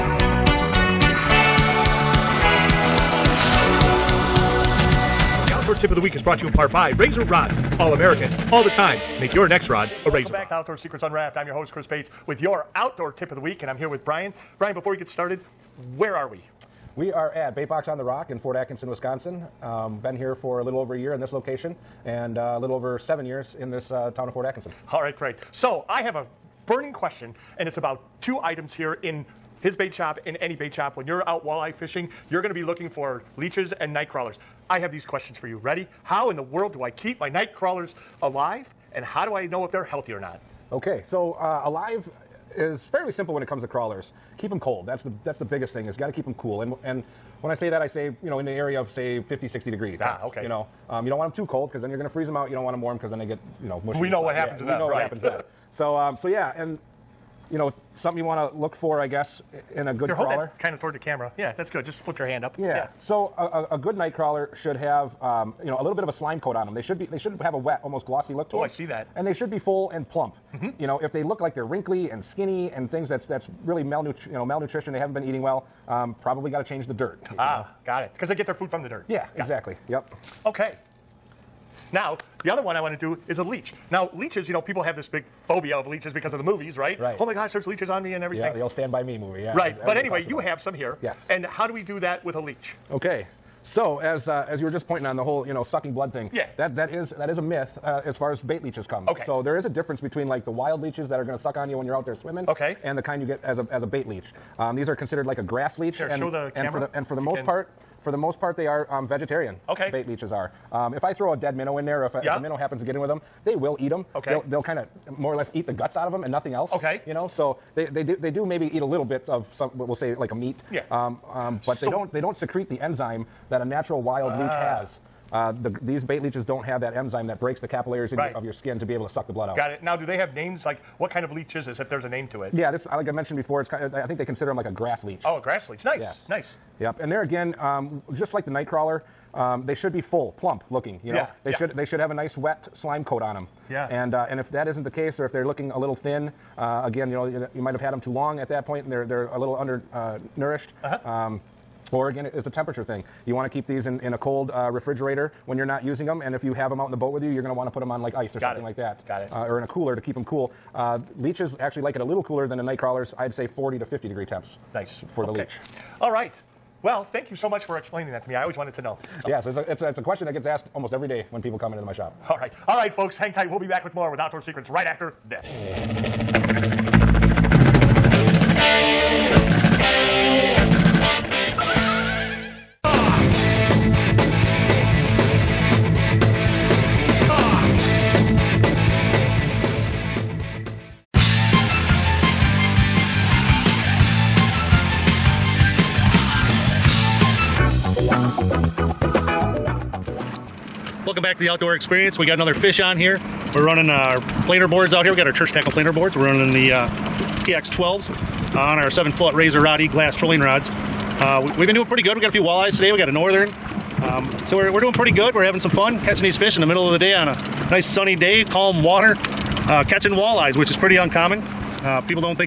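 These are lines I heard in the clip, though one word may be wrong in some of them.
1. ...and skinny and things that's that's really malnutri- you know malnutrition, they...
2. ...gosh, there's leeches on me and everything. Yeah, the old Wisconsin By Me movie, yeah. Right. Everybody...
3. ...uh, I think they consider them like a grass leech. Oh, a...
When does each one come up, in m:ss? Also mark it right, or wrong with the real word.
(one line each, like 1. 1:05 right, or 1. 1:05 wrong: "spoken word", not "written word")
1. 1:12 right
2. 1:27 wrong: "Stand", not "Wisconsin"
3. 2:13 right.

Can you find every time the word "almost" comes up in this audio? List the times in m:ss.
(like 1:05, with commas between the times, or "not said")
1:07, 2:50.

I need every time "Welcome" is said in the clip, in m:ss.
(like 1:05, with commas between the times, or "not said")
0:10, 3:21.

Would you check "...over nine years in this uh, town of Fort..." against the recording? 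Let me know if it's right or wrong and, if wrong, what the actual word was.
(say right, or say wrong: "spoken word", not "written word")
wrong: "seven", not "nine".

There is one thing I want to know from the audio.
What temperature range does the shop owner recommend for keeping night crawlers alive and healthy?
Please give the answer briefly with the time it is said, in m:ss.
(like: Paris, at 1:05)
50 to 60 degrees, at 0:49.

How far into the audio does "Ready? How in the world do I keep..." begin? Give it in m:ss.
0:35.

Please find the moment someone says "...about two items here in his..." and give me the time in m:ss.
0:27.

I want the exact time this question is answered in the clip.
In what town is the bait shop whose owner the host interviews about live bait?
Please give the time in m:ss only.
0:18.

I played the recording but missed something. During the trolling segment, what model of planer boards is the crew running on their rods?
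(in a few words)
TX12.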